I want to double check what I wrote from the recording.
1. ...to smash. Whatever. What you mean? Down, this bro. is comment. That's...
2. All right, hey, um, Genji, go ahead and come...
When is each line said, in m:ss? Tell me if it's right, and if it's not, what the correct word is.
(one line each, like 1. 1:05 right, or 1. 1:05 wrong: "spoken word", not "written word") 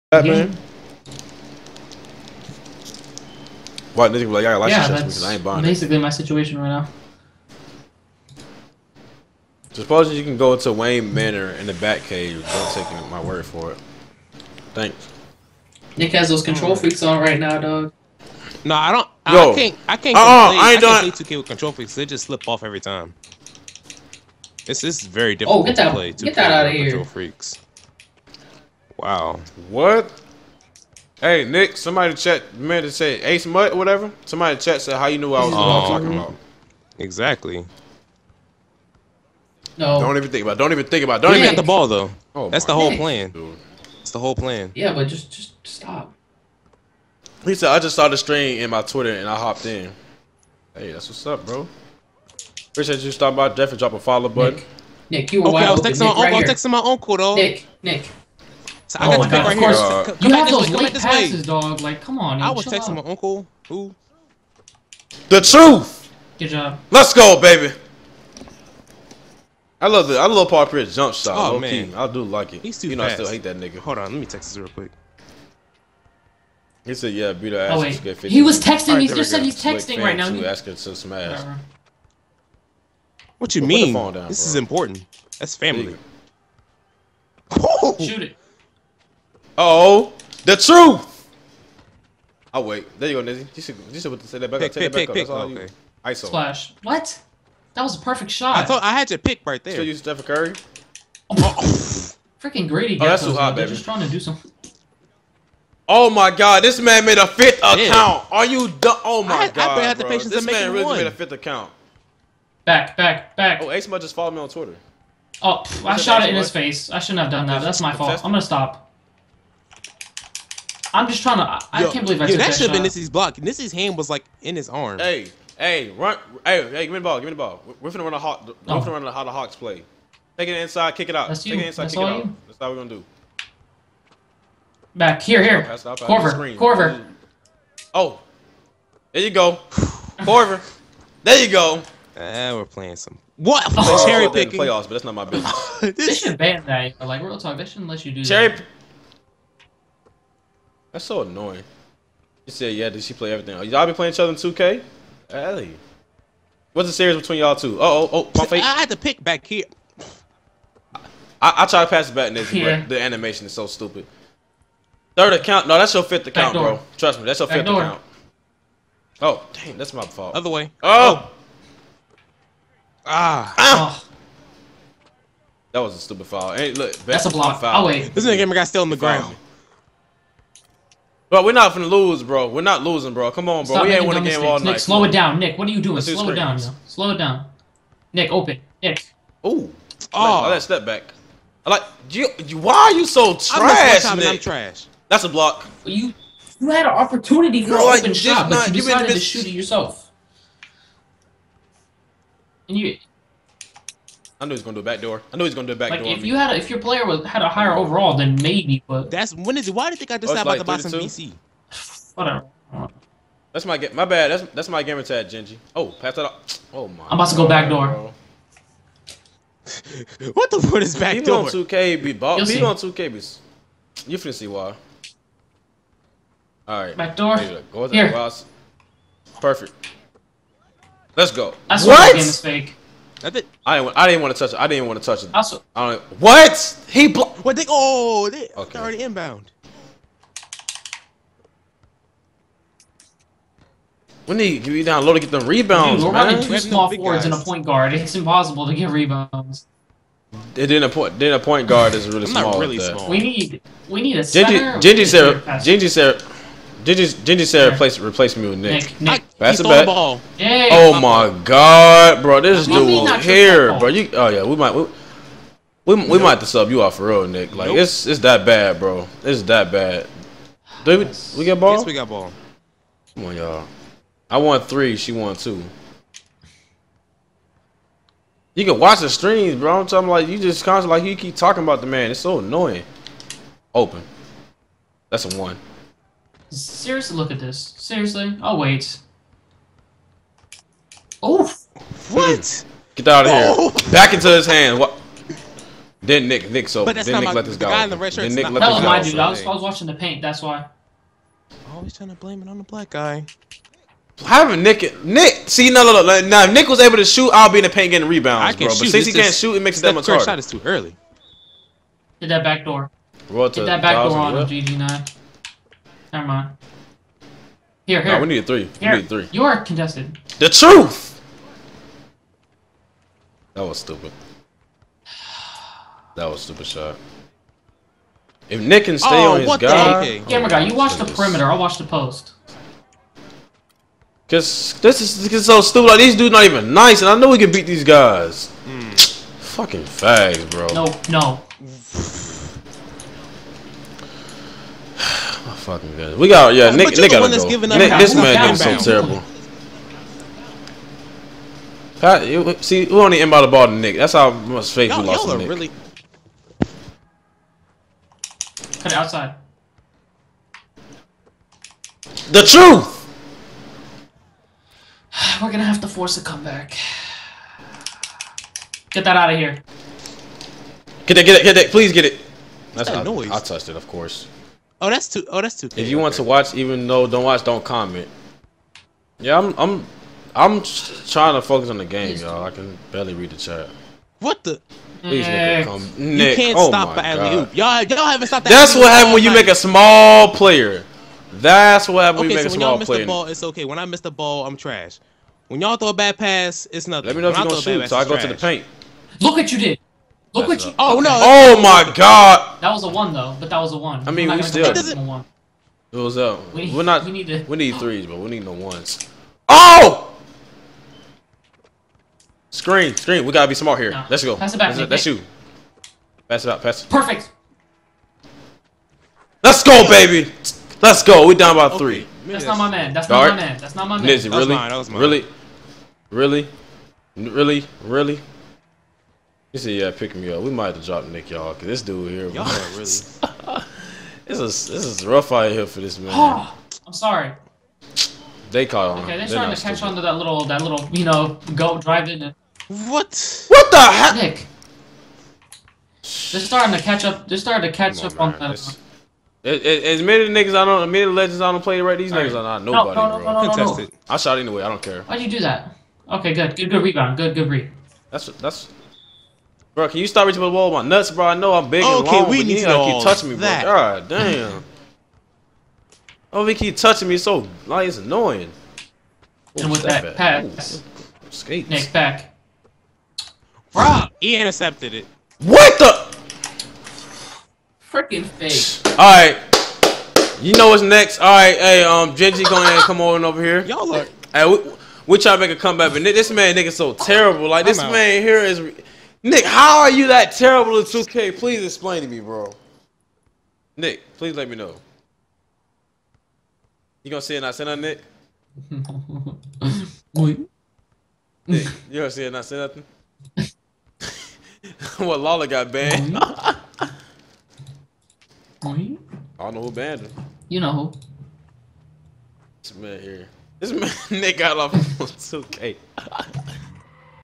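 1. 1:20 wrong: "important", not "comment"
2. 8:01 right.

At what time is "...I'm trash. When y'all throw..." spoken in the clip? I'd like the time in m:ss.
6:34.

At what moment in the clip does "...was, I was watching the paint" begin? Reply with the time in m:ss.
4:59.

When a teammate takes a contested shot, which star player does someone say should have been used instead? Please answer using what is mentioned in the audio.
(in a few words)
Steph Curry.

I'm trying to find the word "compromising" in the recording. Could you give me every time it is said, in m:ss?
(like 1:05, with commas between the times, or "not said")
not said.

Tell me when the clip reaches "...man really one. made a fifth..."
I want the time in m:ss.
1:50.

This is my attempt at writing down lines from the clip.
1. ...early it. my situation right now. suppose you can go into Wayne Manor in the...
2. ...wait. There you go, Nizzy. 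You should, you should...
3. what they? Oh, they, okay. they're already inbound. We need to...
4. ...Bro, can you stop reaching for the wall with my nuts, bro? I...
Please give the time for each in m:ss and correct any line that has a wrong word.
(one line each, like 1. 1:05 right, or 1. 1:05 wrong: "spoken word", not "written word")
1. 0:05 wrong: "basically", not "early"
2. 1:32 right
3. 3:57 right
4. 7:39 right.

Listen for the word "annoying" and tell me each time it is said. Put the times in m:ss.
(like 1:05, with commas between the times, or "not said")
2:31, 4:42, 7:47.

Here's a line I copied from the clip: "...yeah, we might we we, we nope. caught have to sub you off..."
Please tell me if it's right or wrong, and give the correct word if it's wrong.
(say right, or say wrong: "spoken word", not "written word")
wrong: "might", not "caught".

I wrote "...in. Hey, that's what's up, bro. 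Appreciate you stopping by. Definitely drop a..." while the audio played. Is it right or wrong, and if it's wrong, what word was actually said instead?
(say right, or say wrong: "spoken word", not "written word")
right.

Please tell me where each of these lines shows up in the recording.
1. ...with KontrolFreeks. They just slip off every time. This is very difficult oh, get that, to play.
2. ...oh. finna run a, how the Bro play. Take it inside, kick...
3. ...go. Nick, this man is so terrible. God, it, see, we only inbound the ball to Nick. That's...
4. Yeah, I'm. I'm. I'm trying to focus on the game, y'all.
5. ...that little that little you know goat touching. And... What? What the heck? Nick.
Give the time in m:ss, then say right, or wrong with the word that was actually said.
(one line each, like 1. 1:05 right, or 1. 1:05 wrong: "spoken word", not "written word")
1. 0:21 right
2. 2:08 wrong: "Hawks", not "Bro"
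3. 5:47 right
4. 6:19 right
5. 7:20 wrong: "driving", not "touching".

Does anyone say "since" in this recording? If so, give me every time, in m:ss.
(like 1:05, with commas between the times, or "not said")
5:08.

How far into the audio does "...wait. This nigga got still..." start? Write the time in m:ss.
2:57.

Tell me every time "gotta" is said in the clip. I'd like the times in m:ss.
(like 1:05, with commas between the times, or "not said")
5:47, 6:53.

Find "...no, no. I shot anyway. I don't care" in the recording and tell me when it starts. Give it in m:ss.
7:33.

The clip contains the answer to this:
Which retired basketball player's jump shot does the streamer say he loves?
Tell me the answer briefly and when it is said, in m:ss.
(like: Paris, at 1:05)
Paul Pierce, at 1:10.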